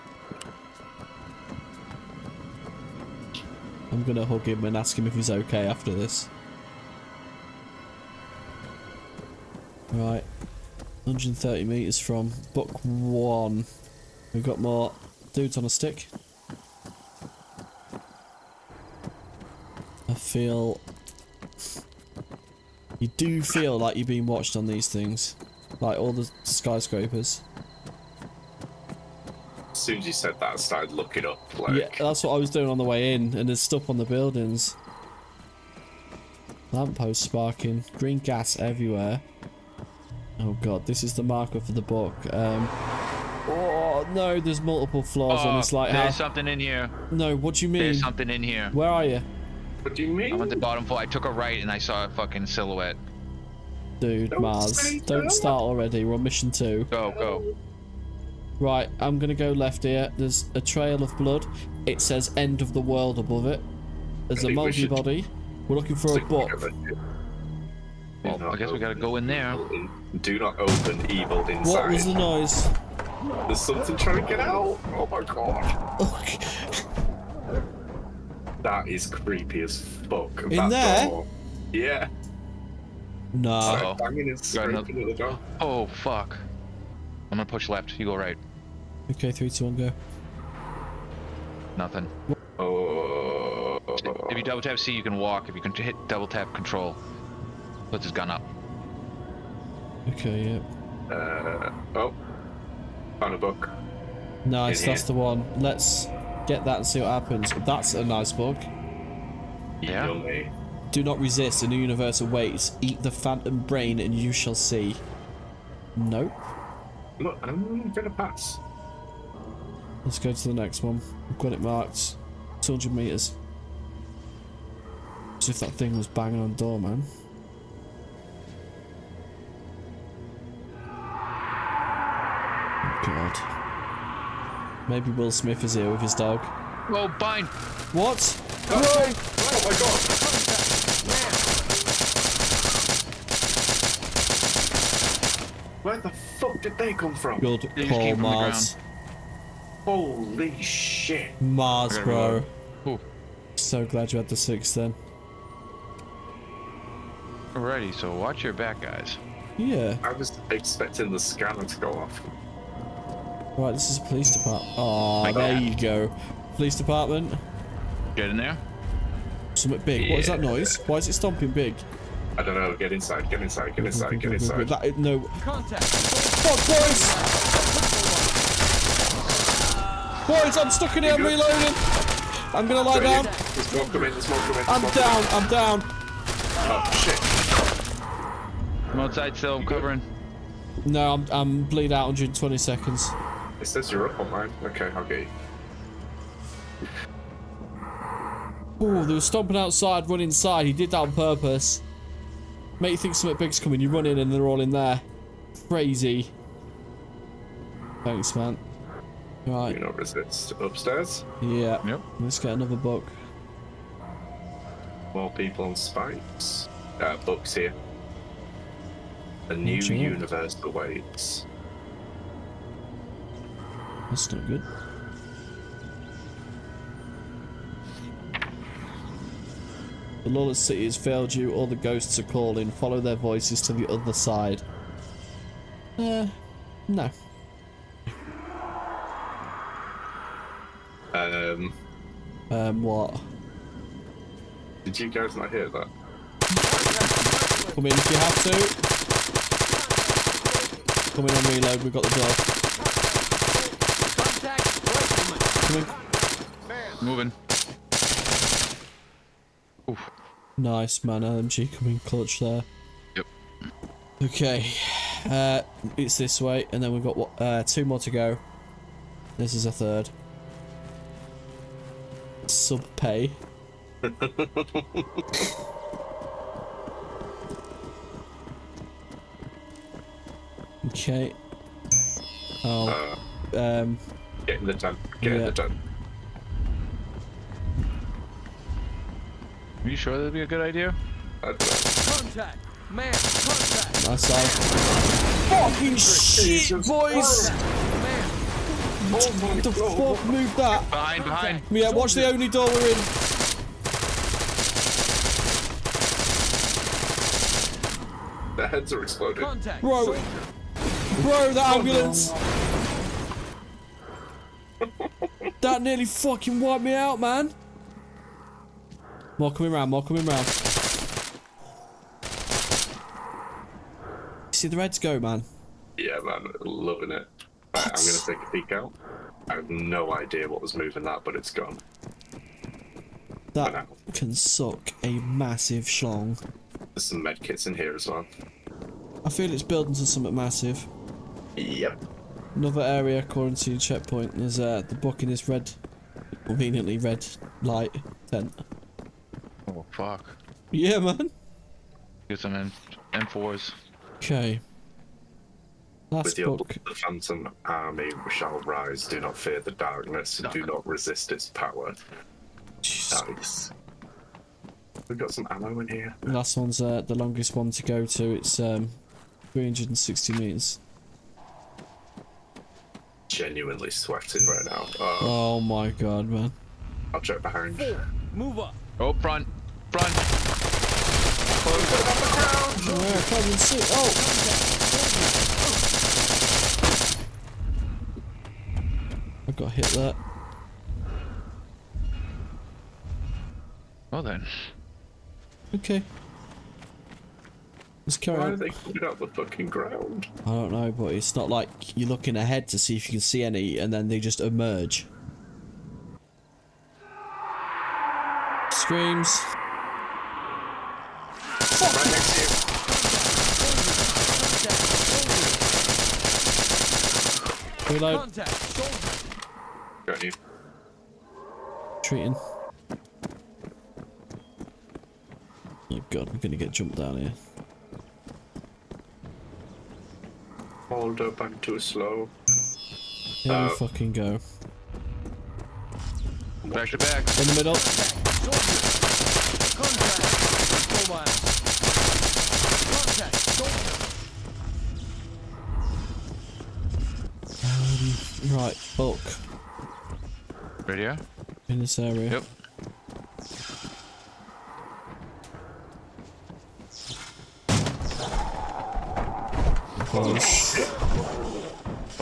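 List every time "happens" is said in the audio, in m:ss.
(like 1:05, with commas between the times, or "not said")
1:47.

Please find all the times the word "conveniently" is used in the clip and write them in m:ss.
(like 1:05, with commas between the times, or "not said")
5:46.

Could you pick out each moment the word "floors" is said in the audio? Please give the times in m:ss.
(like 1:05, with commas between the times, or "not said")
0:45, 0:50.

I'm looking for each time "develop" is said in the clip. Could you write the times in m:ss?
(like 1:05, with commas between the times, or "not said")
not said.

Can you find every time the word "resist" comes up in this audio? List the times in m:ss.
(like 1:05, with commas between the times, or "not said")
1:51, 3:29, 6:00.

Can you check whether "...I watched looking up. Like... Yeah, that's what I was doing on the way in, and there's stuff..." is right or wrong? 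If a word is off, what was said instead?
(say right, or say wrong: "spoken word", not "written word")
wrong: "started", not "watched".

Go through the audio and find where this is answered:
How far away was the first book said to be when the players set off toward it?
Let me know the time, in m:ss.
0:11.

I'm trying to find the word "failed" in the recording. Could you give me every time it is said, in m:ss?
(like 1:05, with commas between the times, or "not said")
3:50.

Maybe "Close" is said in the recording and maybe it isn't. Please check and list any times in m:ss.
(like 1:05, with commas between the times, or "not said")
6:21, 7:40.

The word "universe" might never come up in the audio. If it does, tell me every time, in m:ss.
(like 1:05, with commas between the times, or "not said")
1:51, 3:39.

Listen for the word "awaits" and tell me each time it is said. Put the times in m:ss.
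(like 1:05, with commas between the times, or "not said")
1:52, 3:40.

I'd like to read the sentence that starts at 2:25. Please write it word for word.
Where the fuck did they come from?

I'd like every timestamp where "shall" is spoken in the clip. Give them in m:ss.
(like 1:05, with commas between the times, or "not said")
1:54, 5:58.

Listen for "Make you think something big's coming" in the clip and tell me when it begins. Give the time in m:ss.
3:22.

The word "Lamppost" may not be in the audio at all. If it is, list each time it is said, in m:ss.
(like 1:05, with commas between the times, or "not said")
0:36.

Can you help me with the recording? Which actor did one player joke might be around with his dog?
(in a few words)
Will Smith.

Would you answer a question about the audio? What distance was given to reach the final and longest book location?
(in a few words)
360 meters.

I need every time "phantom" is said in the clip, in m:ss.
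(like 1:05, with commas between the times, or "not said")
1:53, 5:56.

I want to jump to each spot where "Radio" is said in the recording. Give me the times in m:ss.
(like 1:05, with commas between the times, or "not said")
7:30.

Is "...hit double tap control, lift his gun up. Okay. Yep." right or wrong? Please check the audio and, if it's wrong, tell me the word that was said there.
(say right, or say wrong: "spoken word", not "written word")
right.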